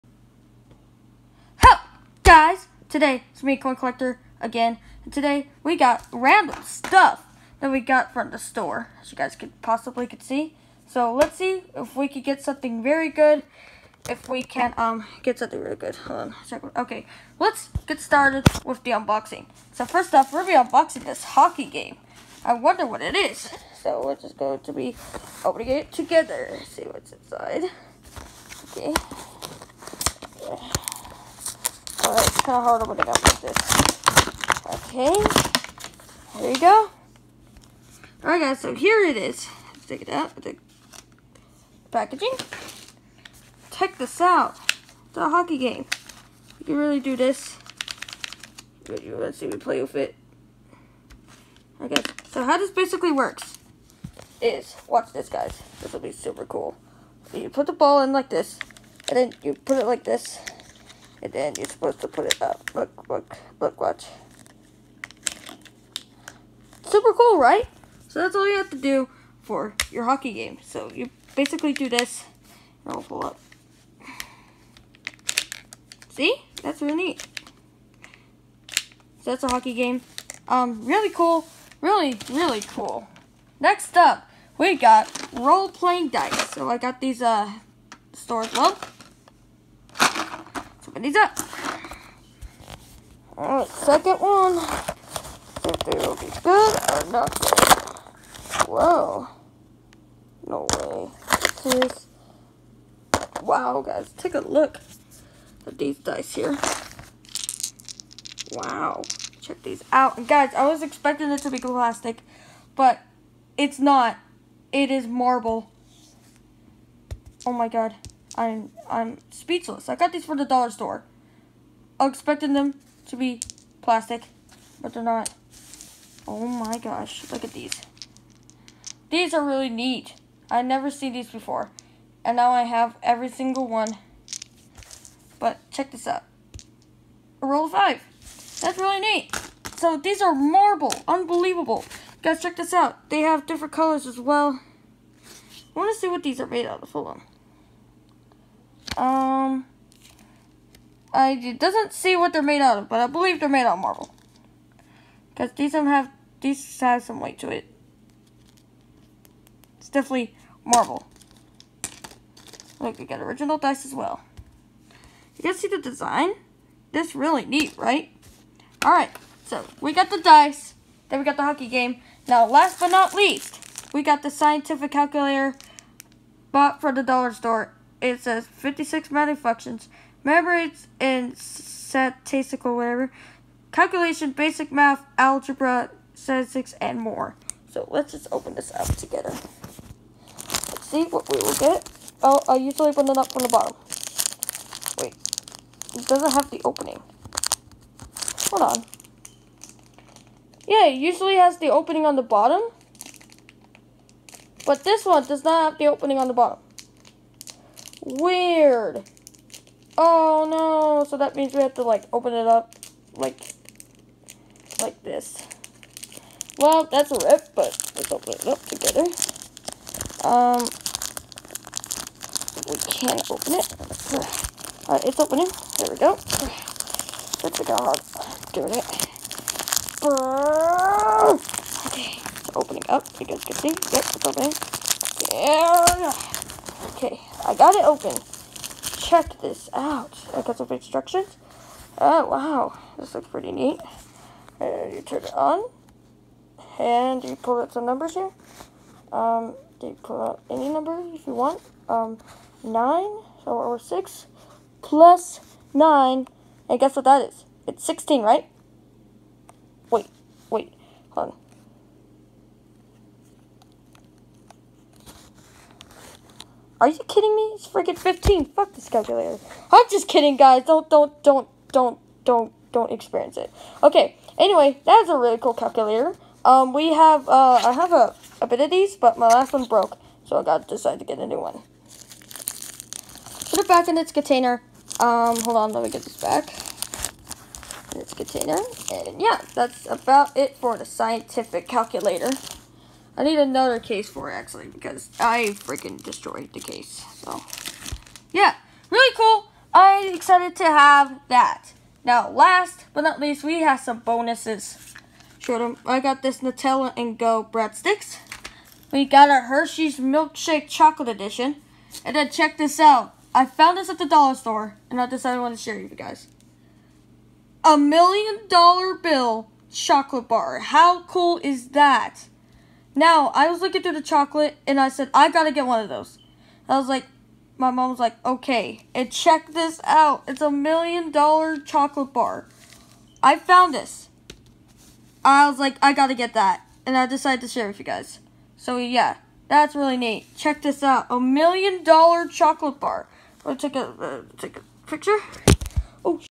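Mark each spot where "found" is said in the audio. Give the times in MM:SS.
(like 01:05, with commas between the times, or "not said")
05:13, 05:33.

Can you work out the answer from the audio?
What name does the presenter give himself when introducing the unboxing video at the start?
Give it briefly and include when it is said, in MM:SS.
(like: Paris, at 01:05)
Coin Collector, at 00:03.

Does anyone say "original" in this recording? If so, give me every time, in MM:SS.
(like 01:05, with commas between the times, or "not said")
02:43.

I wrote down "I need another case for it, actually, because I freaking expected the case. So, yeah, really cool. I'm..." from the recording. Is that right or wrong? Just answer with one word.
wrong.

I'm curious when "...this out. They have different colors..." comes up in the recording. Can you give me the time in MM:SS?
02:22.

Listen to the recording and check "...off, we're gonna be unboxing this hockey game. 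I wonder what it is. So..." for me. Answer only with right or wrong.
right.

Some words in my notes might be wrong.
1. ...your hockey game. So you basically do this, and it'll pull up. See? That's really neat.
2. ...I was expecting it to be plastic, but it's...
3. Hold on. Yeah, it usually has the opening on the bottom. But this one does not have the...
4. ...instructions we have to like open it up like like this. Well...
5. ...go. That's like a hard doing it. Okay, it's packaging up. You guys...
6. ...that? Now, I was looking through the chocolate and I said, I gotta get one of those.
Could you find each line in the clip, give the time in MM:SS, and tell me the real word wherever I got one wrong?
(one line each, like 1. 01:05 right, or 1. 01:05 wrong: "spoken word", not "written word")
1. 01:09 right
2. 01:50 right
3. 03:18 right
4. 03:31 wrong: "means", not "instructions"
5. 03:45 wrong: "opening", not "packaging"
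6. 05:21 right.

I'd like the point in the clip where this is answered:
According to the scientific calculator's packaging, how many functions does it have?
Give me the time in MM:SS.
02:58.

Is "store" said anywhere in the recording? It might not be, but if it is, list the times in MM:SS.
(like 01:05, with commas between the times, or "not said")
00:08, 01:28, 02:00, 02:57, 05:14.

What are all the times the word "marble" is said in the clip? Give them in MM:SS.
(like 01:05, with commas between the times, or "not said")
01:55, 02:20, 02:33, 02:40.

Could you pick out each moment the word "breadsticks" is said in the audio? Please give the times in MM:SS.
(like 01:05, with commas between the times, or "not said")
05:07.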